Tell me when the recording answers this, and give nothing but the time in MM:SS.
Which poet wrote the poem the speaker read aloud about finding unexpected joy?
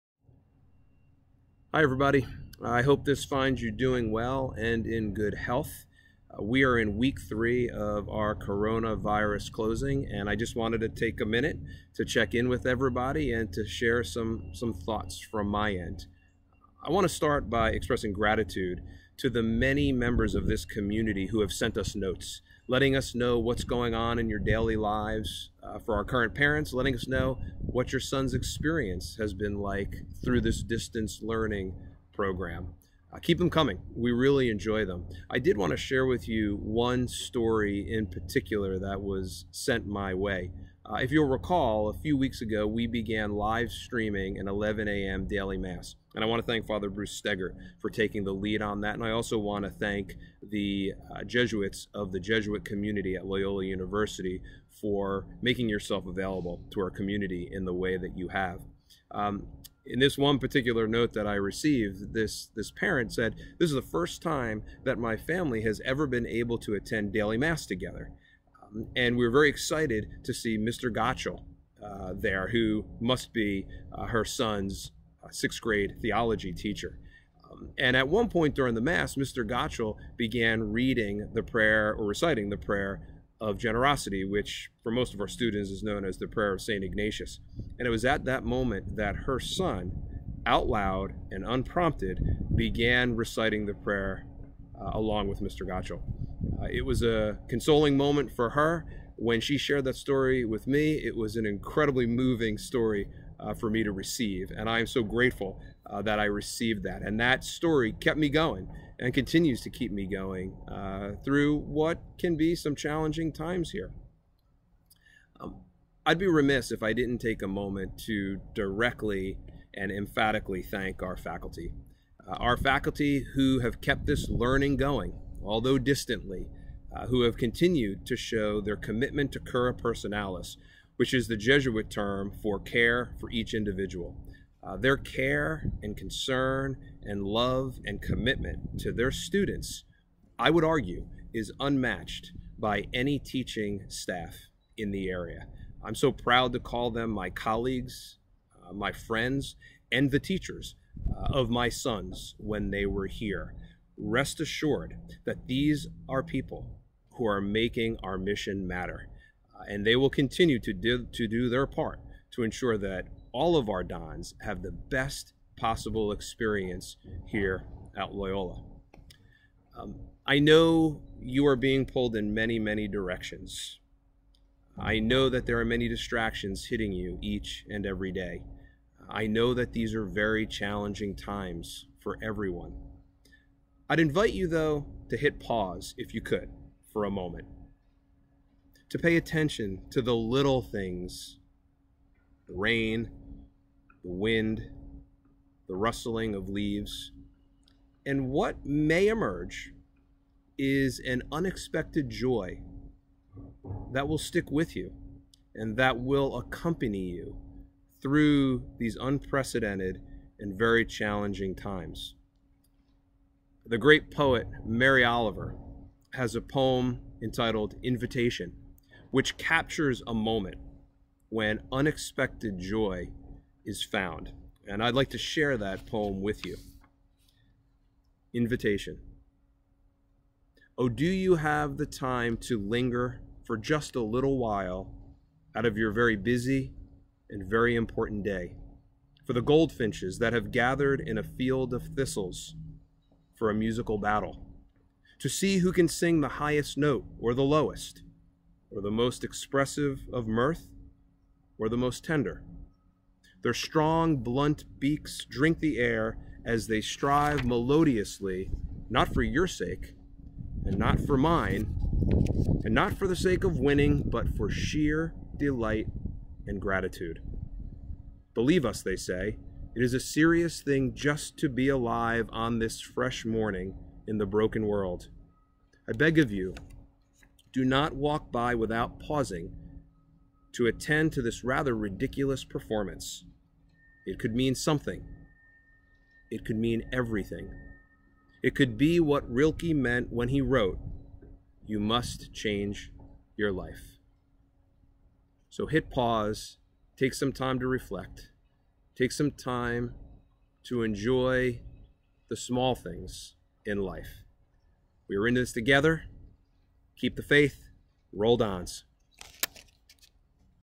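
03:34.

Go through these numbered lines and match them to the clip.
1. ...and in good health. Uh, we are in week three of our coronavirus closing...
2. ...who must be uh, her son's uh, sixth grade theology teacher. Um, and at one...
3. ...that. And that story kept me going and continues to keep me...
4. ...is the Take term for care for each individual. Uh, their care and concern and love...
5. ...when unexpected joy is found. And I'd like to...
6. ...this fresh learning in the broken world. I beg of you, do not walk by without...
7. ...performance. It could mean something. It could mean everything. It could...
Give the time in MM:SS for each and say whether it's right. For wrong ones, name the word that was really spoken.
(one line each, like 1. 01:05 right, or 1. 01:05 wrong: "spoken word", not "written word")
1. 00:04 right
2. 01:12 right
3. 01:46 right
4. 02:11 wrong: "Jesuit", not "Take"
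5. 03:41 right
6. 04:32 wrong: "morning", not "learning"
7. 04:42 right.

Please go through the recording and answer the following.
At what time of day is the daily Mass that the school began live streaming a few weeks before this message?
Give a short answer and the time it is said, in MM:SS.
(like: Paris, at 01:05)
11 a.m., at 00:44.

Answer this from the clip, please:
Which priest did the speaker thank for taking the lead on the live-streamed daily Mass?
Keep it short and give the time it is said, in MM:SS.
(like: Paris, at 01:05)
Father Bruce Steger, at 00:46.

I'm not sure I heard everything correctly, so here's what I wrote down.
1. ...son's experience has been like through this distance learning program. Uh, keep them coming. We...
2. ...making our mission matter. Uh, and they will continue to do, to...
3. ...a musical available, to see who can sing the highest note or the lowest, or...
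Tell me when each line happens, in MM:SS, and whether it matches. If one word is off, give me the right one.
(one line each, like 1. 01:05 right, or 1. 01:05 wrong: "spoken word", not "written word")
1. 00:28 right
2. 02:37 right
3. 04:03 wrong: "battle", not "available".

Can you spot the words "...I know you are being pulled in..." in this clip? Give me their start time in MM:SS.
02:50.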